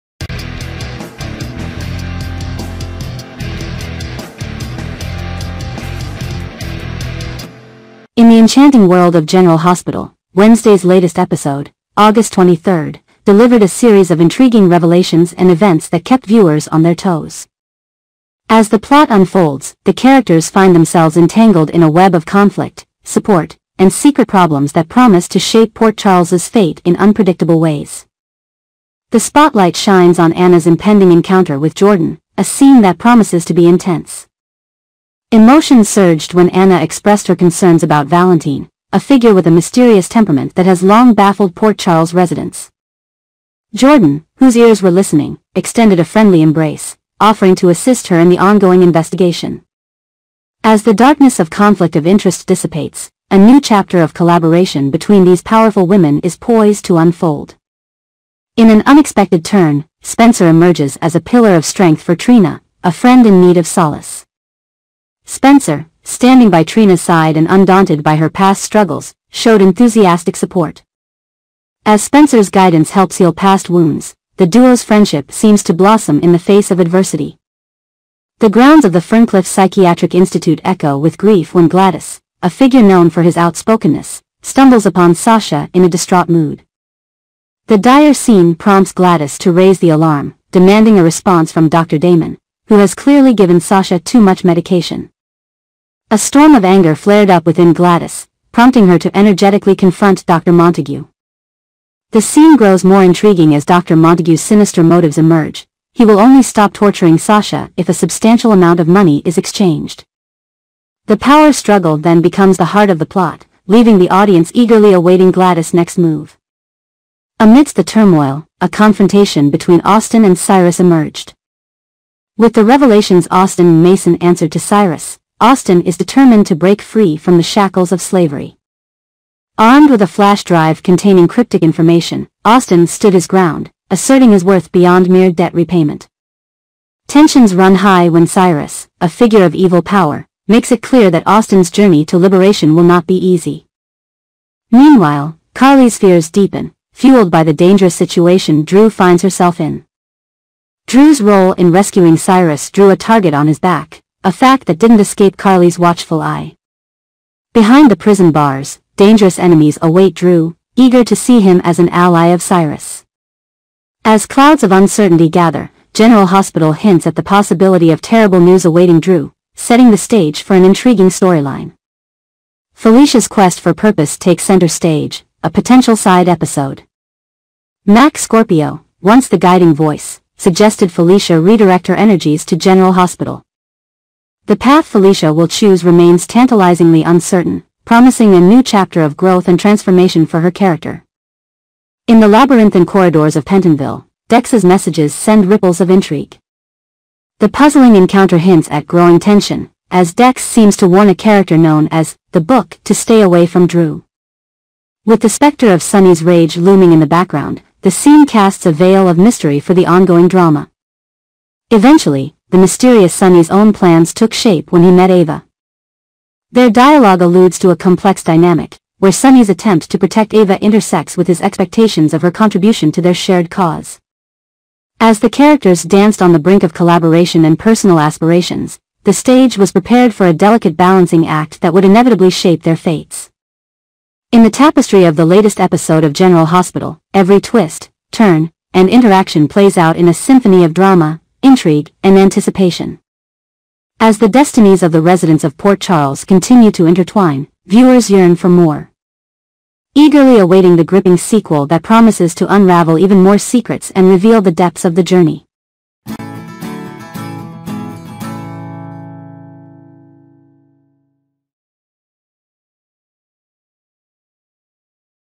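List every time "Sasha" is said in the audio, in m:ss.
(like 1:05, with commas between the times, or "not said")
1:25, 1:33, 1:47.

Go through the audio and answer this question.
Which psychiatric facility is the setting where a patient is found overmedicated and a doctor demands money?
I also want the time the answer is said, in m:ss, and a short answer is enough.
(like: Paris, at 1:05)
Ferncliff Psychiatric Institute, at 1:19.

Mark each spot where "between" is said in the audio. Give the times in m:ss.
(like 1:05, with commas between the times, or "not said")
0:54, 1:59.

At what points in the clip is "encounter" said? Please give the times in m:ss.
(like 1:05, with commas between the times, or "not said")
0:31, 3:17.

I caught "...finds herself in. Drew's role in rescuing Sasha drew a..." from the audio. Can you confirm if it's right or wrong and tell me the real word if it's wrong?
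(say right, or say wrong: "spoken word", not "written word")
wrong: "Cyrus", not "Sasha".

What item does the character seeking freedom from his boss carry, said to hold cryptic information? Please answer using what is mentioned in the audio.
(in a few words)
Flash drive.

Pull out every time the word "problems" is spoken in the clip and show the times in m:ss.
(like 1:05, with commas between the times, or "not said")
0:24.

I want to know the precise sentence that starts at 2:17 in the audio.
Tensions run high when Cyrus, a figure of evil power, makes it clear that Austin's journey to liberation will not be easy.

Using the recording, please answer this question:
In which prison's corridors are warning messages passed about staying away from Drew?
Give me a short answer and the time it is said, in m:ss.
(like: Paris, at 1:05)
Pentonville, at 3:13.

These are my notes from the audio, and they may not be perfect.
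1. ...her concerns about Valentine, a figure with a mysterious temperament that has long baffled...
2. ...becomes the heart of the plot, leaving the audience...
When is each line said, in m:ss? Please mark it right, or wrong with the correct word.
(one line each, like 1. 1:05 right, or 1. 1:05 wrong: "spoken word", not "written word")
1. 0:37 right
2. 1:52 right.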